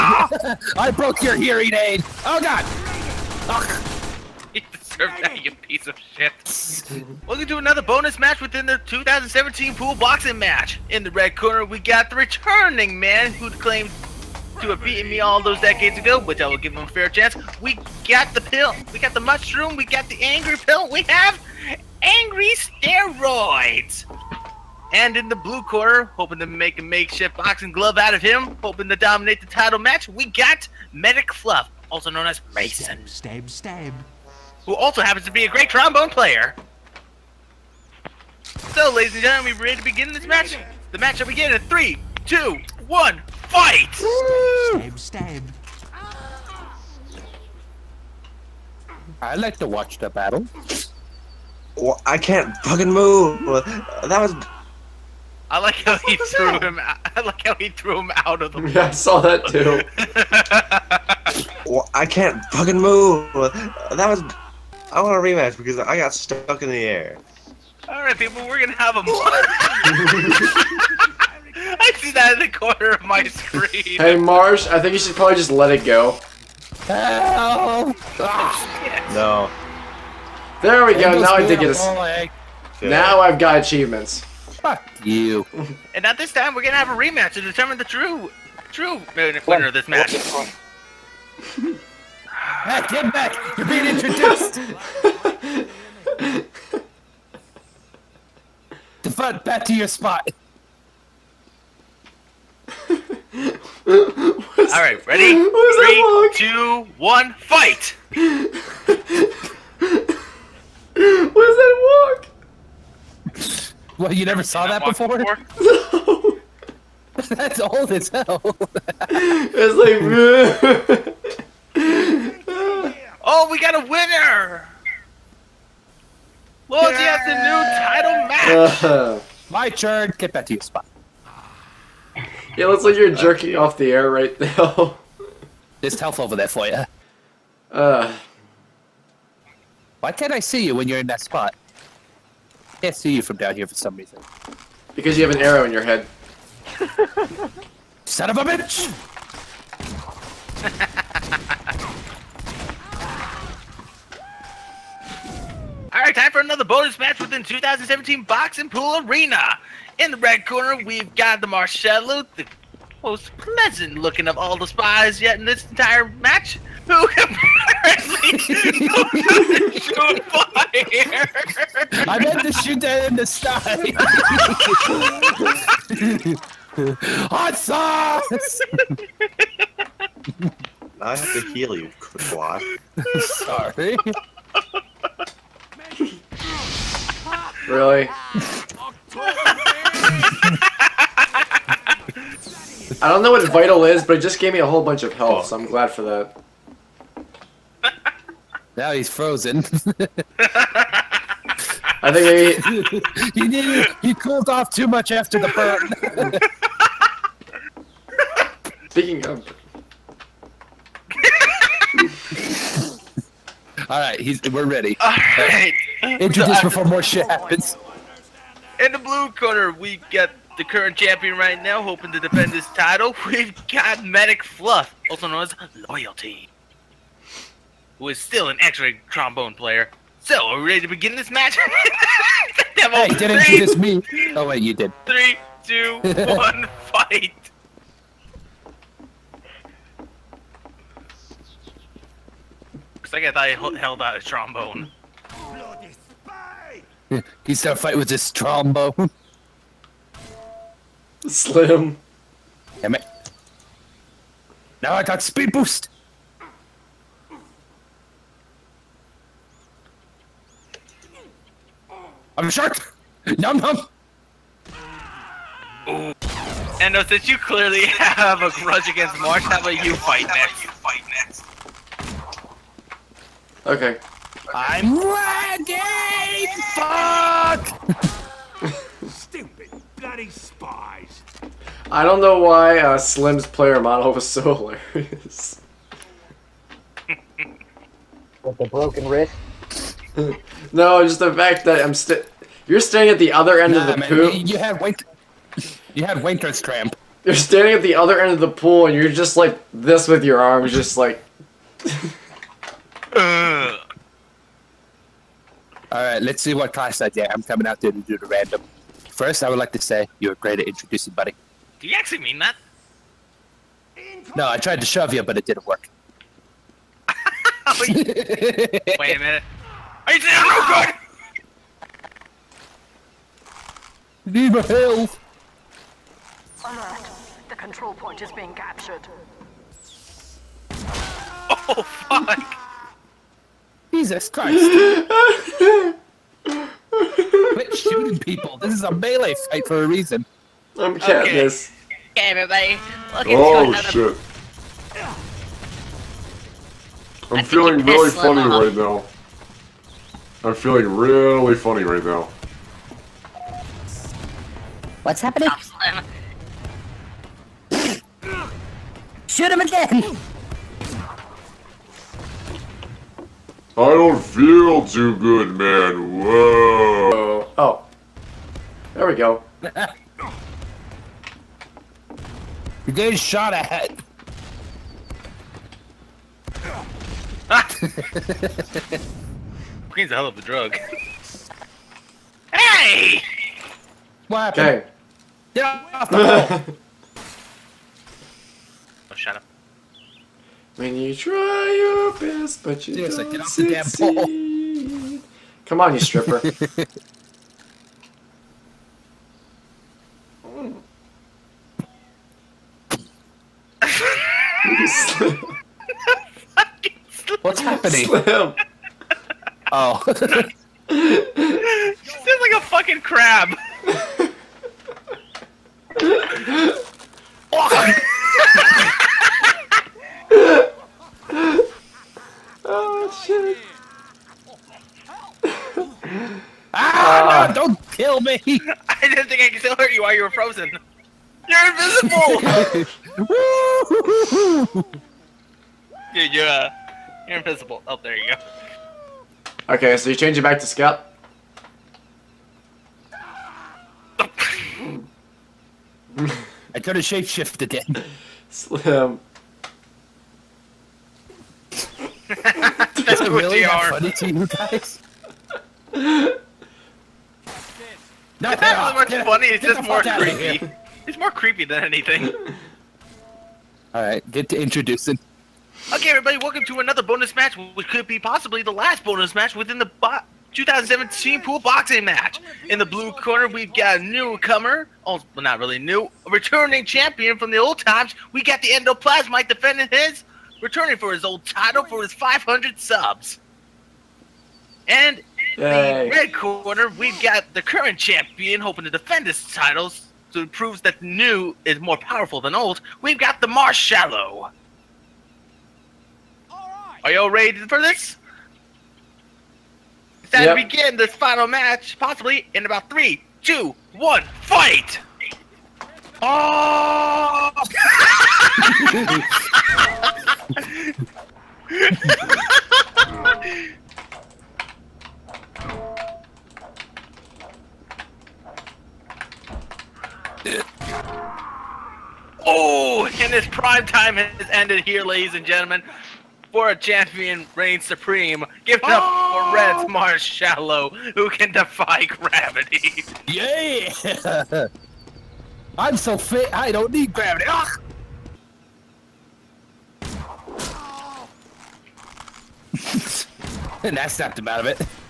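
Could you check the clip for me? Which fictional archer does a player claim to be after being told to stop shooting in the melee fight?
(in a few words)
Katniss.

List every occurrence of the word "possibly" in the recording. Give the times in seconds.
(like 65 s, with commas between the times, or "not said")
468 s, 501 s.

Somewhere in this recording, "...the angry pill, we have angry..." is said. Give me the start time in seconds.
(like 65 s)
20 s.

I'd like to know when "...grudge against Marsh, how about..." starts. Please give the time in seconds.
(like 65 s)
268 s.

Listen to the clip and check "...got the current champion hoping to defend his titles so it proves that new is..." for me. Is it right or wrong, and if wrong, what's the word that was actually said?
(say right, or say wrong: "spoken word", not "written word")
right.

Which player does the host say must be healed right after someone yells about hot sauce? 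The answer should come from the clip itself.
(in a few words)
Quad.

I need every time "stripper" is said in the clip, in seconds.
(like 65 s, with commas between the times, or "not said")
395 s.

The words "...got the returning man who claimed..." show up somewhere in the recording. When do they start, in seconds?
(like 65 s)
11 s.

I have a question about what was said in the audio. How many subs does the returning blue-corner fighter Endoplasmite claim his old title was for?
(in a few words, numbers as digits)
500.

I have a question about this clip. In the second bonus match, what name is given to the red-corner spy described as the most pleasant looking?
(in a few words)
Marcello.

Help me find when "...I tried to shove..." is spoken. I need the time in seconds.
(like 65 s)
314 s.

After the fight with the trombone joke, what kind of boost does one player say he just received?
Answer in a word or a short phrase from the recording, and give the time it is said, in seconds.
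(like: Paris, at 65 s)
Speed boost, at 255 s.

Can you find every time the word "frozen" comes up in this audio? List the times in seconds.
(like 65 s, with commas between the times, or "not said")
199 s, 430 s.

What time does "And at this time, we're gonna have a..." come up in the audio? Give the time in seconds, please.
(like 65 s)
85 s.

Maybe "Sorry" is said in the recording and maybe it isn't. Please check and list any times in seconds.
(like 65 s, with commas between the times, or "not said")
183 s.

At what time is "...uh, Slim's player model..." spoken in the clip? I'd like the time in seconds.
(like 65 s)
282 s.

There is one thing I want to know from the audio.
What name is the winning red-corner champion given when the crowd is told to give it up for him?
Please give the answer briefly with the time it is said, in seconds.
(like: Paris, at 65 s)
Marshmallow, at 529 s.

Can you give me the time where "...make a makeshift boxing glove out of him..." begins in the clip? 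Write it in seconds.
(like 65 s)
26 s.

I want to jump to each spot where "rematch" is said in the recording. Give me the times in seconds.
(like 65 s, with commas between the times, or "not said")
65 s, 86 s.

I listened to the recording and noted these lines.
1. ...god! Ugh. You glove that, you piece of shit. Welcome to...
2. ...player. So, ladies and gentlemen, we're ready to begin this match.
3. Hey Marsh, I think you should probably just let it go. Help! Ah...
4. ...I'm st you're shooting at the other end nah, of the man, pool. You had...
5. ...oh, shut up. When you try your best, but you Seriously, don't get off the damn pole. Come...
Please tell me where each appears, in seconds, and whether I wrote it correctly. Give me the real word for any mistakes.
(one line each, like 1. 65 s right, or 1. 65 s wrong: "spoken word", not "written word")
1. 2 s wrong: "deserve", not "glove"
2. 36 s right
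3. 73 s right
4. 291 s wrong: "standing", not "shooting"
5. 389 s right.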